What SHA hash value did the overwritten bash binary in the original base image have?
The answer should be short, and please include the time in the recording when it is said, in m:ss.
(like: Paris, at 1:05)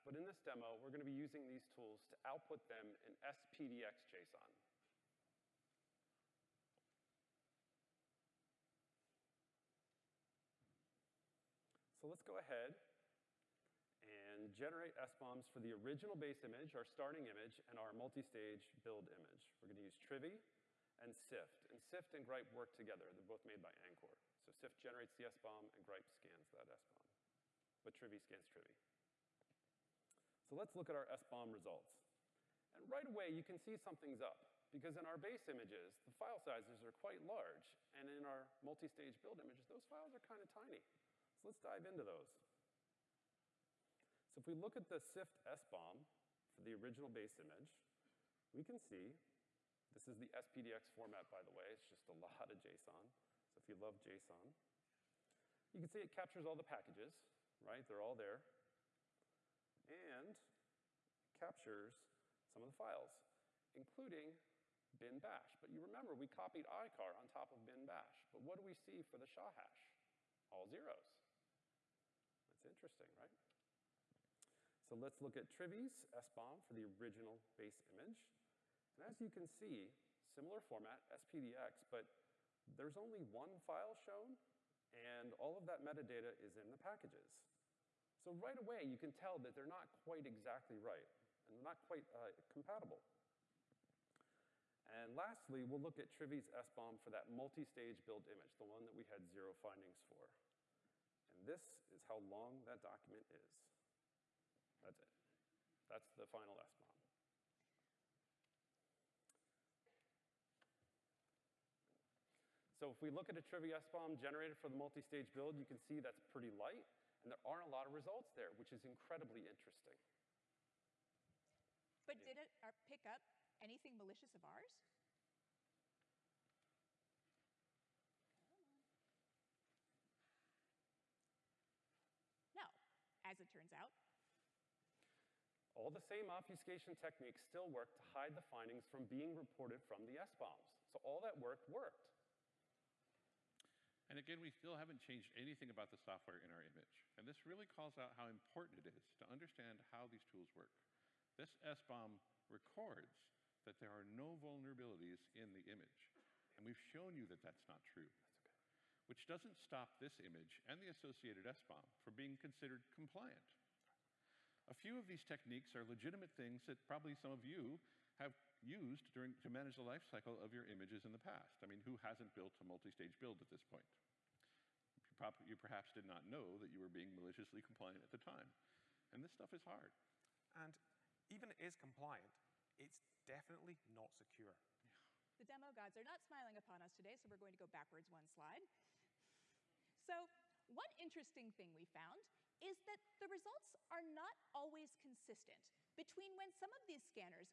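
all zeros, at 1:10.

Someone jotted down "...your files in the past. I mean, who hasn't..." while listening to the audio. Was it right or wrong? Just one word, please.
wrong.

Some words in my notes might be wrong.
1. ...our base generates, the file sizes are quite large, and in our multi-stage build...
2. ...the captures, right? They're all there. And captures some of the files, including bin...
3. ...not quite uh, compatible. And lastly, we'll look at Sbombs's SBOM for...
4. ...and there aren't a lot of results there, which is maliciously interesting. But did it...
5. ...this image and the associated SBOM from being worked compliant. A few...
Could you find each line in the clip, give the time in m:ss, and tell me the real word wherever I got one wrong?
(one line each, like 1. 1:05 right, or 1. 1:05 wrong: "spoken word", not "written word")
1. 0:35 wrong: "images", not "generates"
2. 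0:56 wrong: "packages", not "captures"
3. 1:31 wrong: "Trivi", not "Sbombs"
4. 1:57 wrong: "incredibly", not "maliciously"
5. 2:39 wrong: "considered", not "worked".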